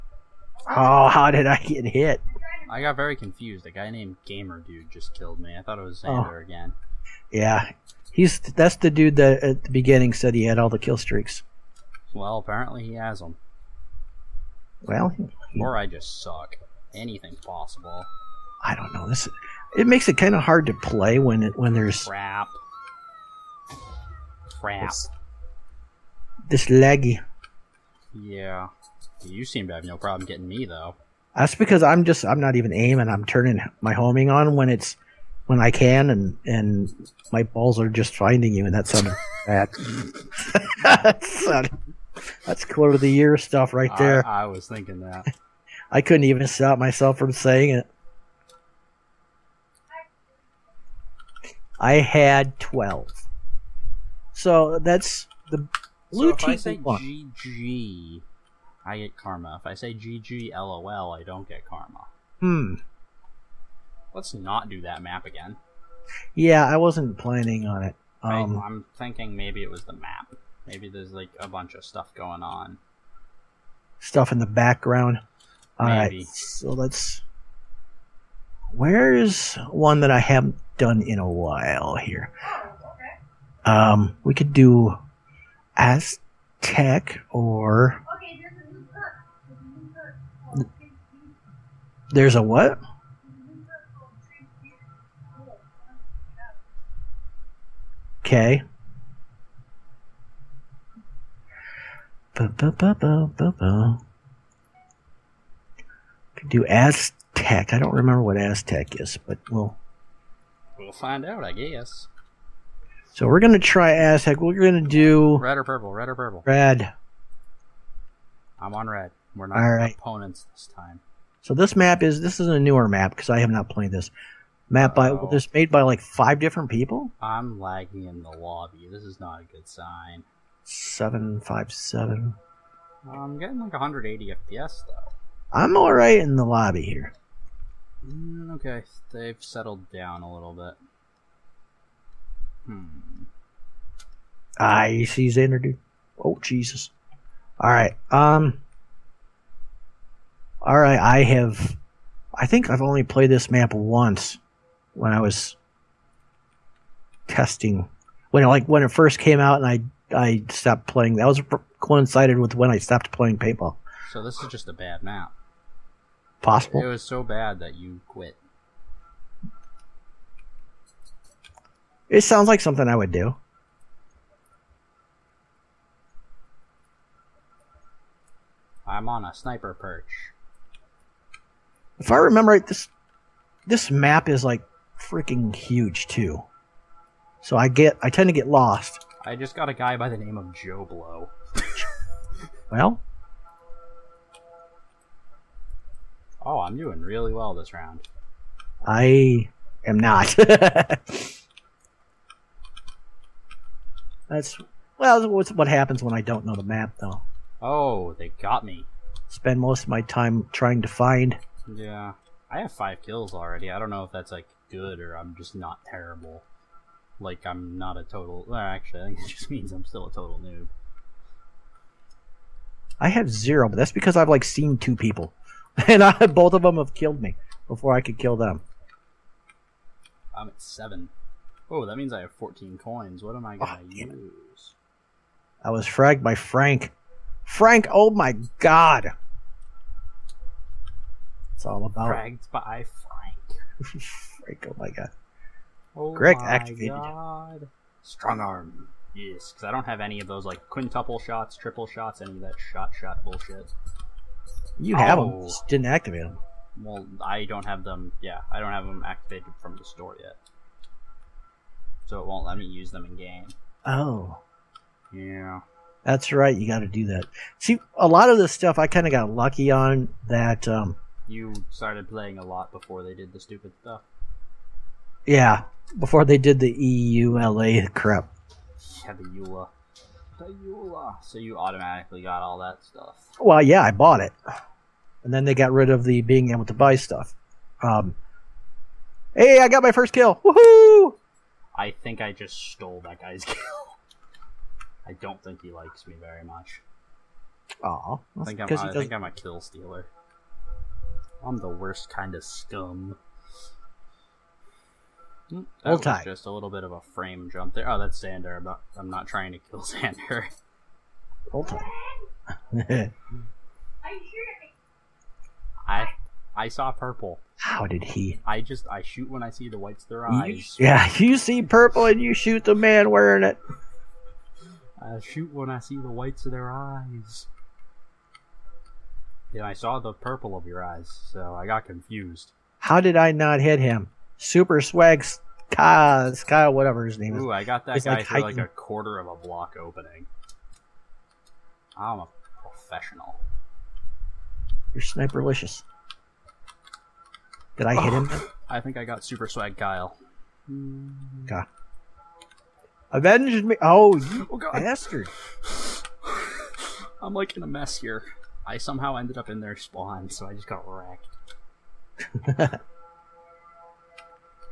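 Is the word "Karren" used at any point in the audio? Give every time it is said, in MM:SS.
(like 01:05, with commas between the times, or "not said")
not said.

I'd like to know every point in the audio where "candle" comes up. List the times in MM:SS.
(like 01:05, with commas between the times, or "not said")
not said.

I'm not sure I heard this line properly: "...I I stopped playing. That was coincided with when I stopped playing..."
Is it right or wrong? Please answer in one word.
right.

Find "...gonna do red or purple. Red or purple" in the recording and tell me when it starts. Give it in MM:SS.
01:54.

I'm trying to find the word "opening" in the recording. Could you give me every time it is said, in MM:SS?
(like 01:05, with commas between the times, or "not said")
05:39.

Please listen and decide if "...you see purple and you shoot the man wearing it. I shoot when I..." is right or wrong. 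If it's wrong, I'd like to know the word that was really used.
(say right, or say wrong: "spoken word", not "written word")
right.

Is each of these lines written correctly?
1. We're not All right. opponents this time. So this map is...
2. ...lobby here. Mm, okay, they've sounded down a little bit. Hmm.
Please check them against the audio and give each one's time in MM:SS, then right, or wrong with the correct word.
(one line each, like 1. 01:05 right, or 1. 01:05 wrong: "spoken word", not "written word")
1. 01:59 right
2. 02:16 wrong: "settled", not "sounded".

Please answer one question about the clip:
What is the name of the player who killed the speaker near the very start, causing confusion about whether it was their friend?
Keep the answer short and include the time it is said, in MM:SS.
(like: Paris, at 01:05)
Gamer Dude, at 00:04.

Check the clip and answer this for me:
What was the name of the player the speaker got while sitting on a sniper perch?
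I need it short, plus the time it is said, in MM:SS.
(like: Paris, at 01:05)
Joe Blow, at 03:10.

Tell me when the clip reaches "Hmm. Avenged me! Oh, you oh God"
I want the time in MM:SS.
05:51.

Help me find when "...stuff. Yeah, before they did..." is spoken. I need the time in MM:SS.
04:33.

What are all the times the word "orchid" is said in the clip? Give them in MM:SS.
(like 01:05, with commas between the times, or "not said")
not said.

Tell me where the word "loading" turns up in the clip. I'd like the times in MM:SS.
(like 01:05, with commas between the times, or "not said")
not said.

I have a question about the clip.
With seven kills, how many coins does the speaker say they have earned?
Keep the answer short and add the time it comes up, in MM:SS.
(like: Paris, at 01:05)
14, at 03:52.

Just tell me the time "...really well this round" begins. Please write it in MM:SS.
03:16.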